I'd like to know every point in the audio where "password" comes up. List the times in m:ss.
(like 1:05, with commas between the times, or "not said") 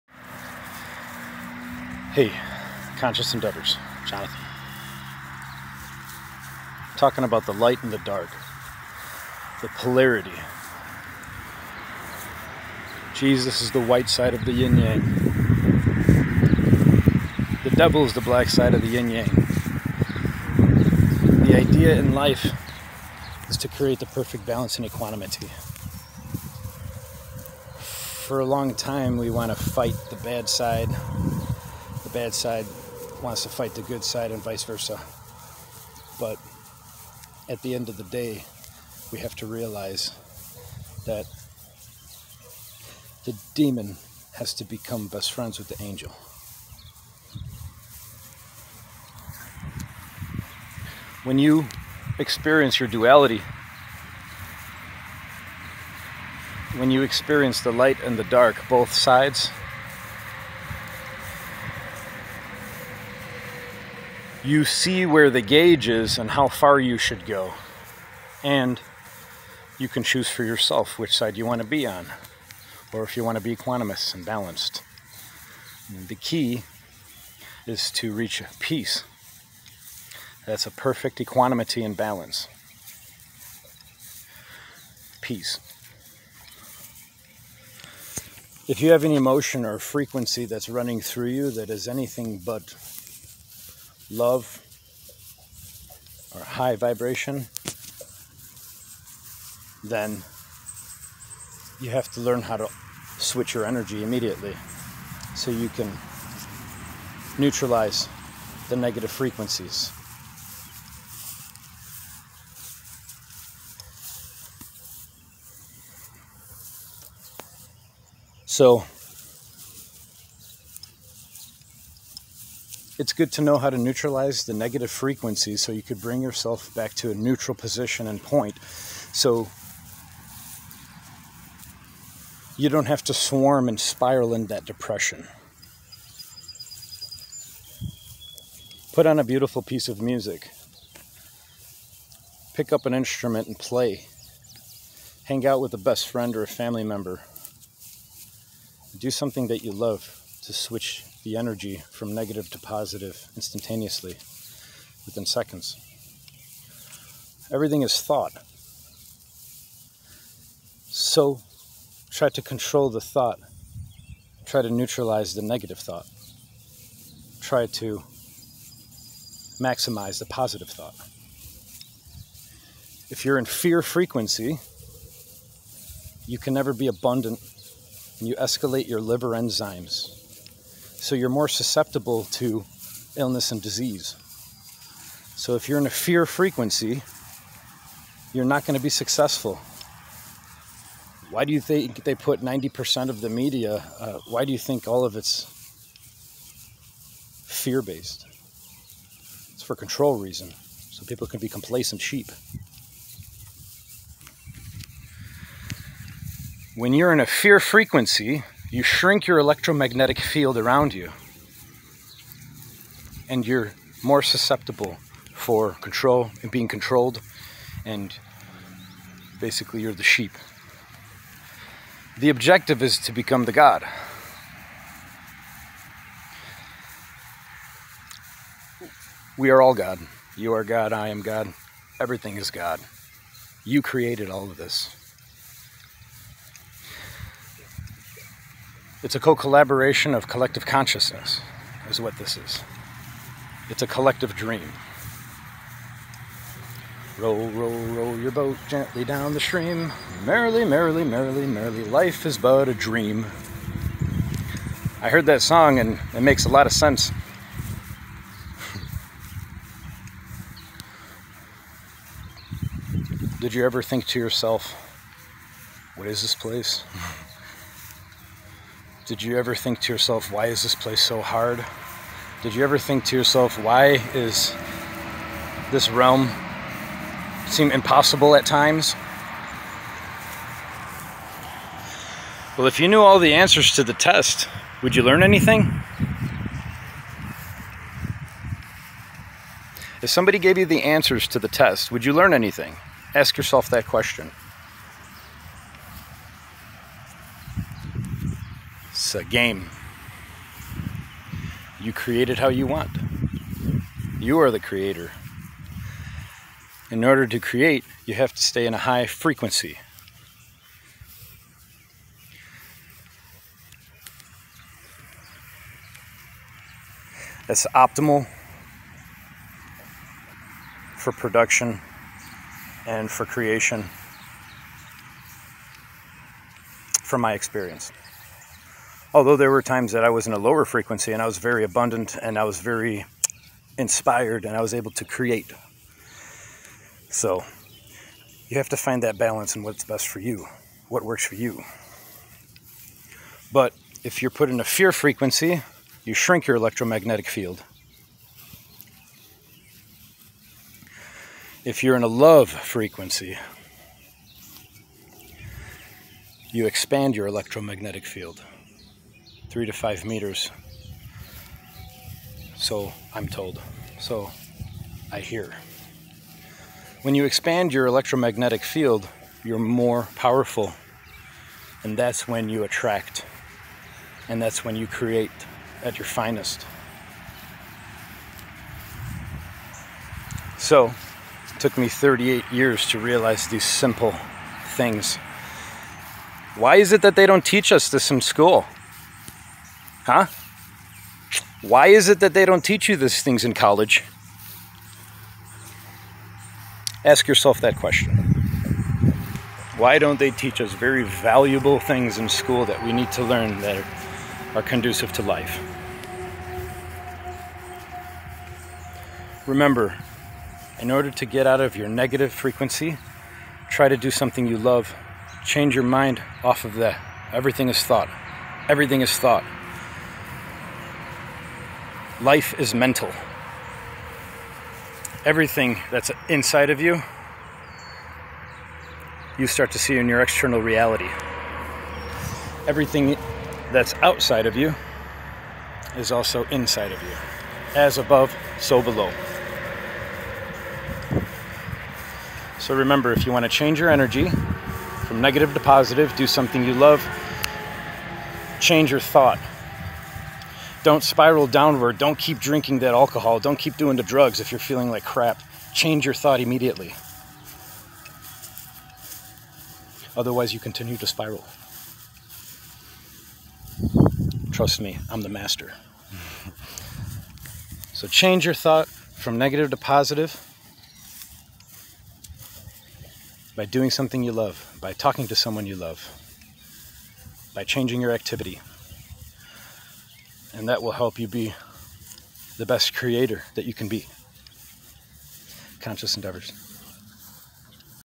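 not said.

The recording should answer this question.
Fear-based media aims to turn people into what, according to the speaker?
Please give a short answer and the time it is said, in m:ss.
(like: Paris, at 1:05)
complacent sheep, at 3:21.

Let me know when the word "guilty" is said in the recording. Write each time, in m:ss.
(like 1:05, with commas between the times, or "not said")
not said.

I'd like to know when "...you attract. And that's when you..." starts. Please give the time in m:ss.
6:12.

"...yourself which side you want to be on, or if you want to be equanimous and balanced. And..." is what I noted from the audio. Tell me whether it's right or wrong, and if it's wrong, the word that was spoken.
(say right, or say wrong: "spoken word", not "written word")
right.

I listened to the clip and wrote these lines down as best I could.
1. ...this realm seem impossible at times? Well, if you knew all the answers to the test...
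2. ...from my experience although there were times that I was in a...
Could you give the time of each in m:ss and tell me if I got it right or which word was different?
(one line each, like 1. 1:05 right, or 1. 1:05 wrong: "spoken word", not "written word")
1. 4:35 right
2. 5:27 right.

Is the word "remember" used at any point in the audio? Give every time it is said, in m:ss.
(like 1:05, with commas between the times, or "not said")
6:49, 7:22.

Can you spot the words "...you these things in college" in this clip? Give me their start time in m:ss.
6:32.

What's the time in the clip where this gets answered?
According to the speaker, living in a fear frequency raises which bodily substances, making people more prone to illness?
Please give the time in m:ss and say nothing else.
2:59.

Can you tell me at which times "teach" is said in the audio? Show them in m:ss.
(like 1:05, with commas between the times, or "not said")
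6:27, 6:32, 6:40.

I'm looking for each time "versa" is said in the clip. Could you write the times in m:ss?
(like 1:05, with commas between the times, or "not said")
0:34.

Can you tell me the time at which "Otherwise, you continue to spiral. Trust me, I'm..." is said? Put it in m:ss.
7:40.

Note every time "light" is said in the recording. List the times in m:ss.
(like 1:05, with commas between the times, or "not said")
0:07, 0:57.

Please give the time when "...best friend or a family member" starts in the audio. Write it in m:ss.
2:25.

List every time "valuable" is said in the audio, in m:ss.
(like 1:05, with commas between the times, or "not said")
6:41.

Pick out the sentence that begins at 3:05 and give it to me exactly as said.
So if you're in a fear frequency, you're not going to be successful.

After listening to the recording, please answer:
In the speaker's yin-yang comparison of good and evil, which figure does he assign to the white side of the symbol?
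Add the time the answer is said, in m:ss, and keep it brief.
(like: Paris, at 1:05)
Jesus, at 0:13.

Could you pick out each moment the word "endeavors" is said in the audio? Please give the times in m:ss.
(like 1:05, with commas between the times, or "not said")
0:03, 8:06.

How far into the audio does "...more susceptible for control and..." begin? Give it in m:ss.
3:34.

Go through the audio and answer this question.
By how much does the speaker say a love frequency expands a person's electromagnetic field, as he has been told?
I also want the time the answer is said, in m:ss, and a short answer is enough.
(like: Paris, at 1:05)
3 to 5 meters, at 5:59.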